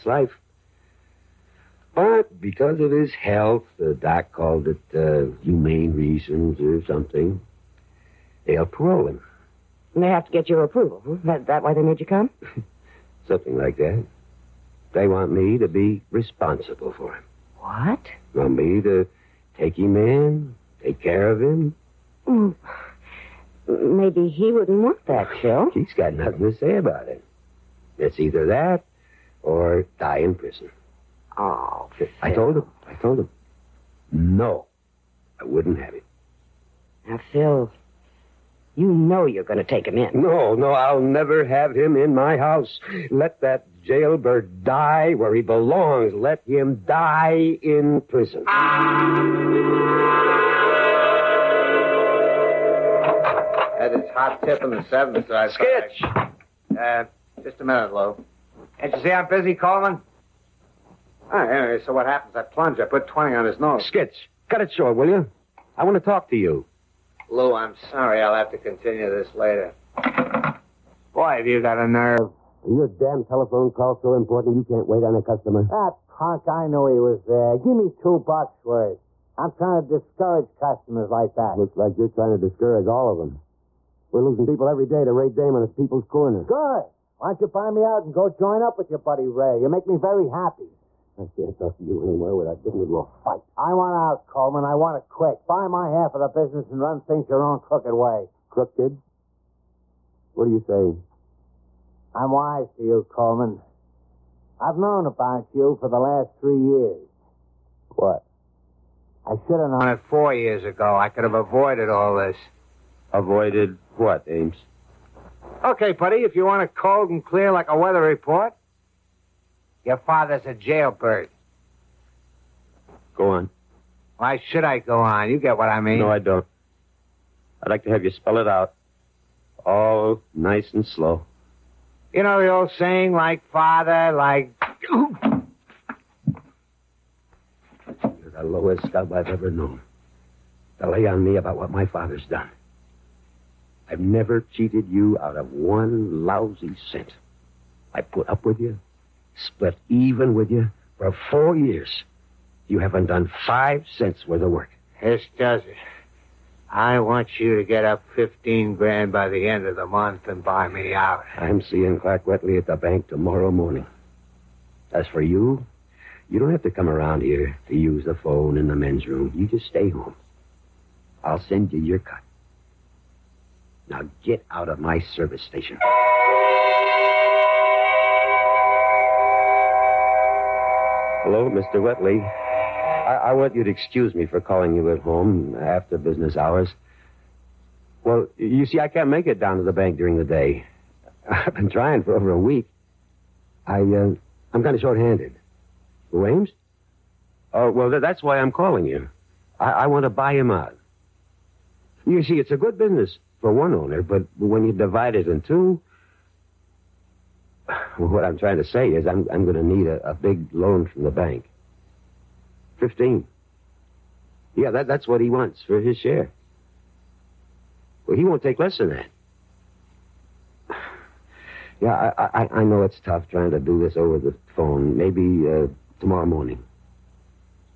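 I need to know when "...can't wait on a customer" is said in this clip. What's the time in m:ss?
1:14.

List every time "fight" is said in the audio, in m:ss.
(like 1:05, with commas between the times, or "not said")
1:33.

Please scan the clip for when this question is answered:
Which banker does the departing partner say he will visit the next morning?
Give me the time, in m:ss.
2:41.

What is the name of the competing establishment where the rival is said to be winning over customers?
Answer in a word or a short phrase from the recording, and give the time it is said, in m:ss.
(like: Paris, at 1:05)
People's Corner, at 1:25.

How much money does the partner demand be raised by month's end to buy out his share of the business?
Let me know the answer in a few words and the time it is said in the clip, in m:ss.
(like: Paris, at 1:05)
15 grand, at 2:38.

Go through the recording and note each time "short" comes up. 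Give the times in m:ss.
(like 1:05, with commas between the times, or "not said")
1:04, 3:14.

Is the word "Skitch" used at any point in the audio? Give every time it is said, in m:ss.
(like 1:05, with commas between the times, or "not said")
0:55, 1:03.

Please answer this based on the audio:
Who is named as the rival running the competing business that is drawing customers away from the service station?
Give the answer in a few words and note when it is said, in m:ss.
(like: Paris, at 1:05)
Ray Damon, at 1:25.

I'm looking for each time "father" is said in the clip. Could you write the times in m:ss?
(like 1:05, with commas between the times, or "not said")
1:59, 2:13, 2:21.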